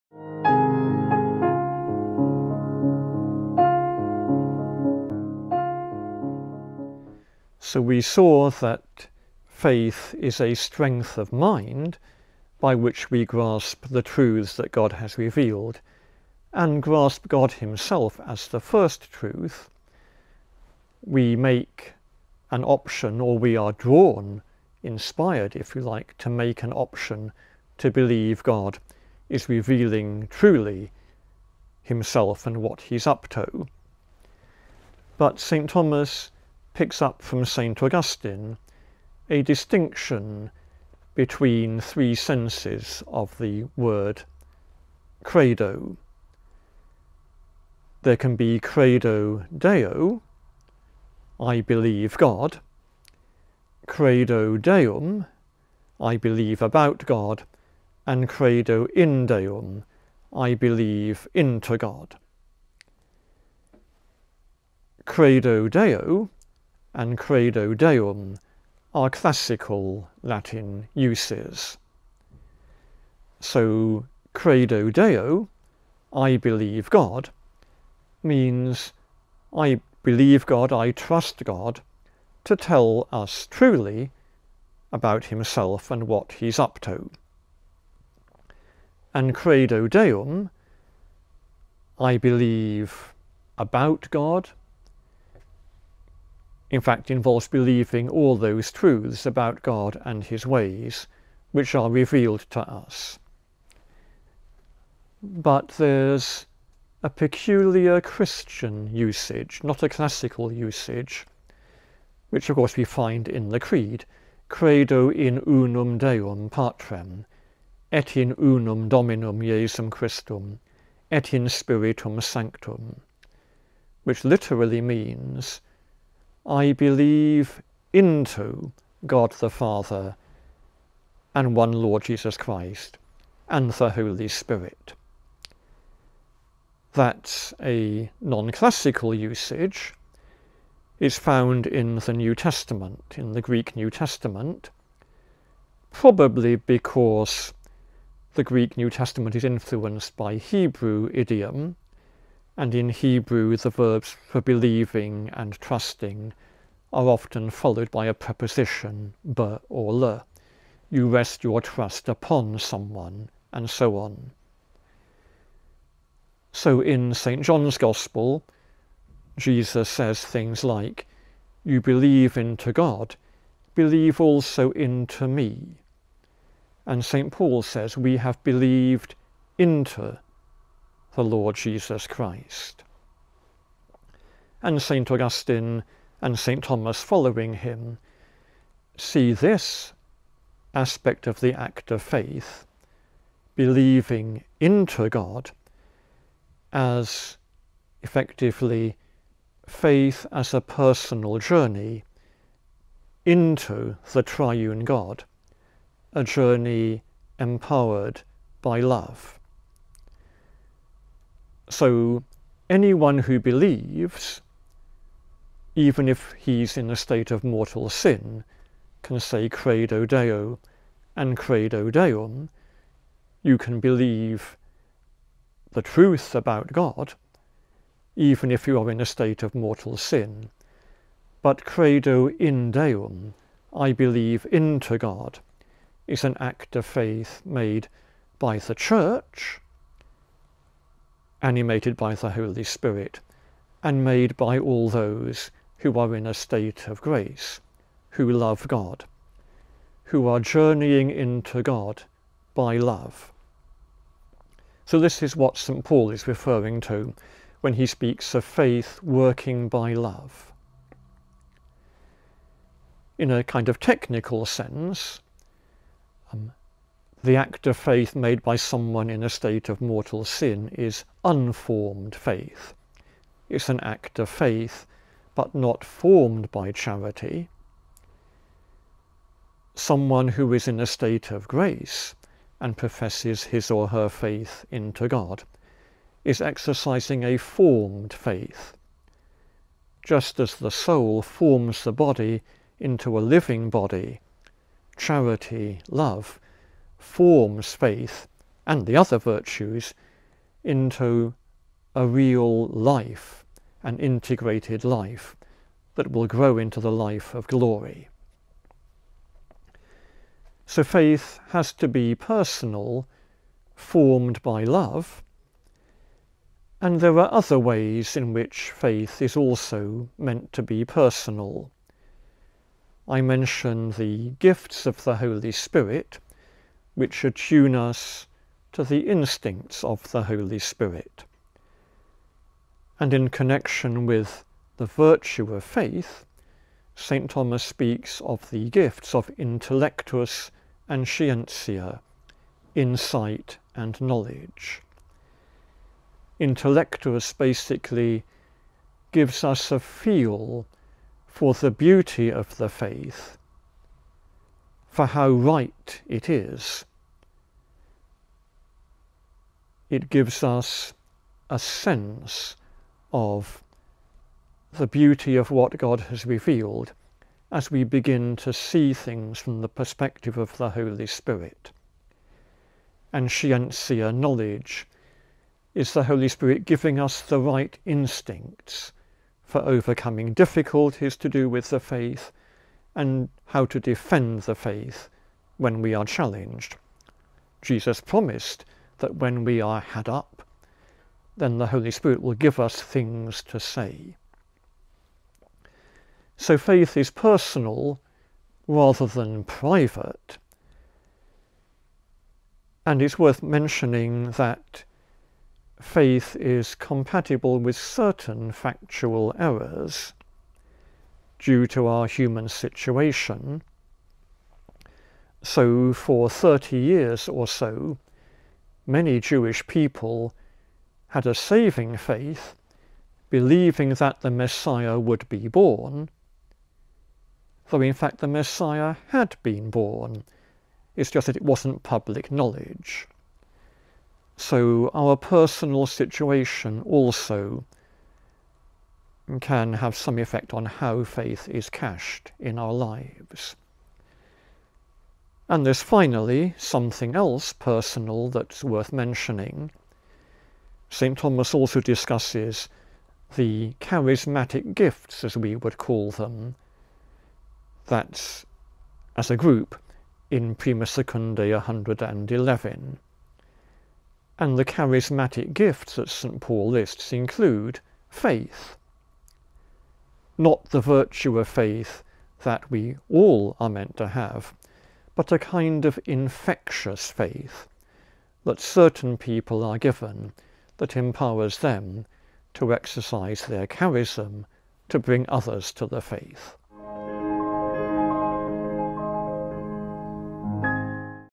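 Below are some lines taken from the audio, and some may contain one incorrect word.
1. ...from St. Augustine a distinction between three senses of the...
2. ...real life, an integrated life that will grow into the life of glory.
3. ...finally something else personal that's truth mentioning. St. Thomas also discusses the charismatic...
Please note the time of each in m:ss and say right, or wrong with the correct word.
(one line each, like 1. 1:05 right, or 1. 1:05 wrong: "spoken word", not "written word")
1. 0:37 right
2. 5:02 right
3. 7:25 wrong: "worth", not "truth".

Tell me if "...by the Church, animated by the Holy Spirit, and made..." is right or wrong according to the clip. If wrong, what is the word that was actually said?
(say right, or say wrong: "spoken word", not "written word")
right.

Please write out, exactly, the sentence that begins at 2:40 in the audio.
You rest your trust upon someone, and so on.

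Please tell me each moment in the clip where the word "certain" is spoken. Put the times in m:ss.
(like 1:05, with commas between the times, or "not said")
6:47, 7:58.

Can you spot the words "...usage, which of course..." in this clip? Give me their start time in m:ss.
1:50.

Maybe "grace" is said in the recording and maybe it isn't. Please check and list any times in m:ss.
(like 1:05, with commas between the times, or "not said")
4:07, 4:41.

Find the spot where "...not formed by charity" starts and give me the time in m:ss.
4:35.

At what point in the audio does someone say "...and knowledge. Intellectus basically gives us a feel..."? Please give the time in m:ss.
5:43.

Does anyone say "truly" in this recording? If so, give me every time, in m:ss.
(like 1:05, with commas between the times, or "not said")
0:30, 1:23.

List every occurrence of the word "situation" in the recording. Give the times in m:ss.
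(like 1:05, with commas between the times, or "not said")
6:52, 7:15.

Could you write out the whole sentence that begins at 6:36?
So faith is personal rather than private.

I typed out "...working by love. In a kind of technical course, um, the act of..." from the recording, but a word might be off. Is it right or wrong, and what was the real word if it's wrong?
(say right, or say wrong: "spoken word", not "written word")
wrong: "sense", not "course".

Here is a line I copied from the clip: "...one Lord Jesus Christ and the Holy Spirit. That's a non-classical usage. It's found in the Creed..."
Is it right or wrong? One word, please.
wrong.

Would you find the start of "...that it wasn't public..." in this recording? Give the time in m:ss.
7:11.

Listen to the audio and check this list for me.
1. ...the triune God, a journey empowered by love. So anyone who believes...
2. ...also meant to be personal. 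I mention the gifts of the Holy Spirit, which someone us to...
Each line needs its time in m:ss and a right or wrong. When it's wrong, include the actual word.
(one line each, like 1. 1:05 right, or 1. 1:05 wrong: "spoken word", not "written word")
1. 3:24 right
2. 5:19 wrong: "attune", not "someone".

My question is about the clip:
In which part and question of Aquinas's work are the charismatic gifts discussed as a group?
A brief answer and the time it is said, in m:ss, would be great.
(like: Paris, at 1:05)
Prima Secundae 111, at 7:40.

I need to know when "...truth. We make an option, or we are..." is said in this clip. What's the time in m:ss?
0:19.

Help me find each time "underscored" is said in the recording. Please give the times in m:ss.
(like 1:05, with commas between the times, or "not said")
not said.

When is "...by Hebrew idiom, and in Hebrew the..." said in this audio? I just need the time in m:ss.
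2:30.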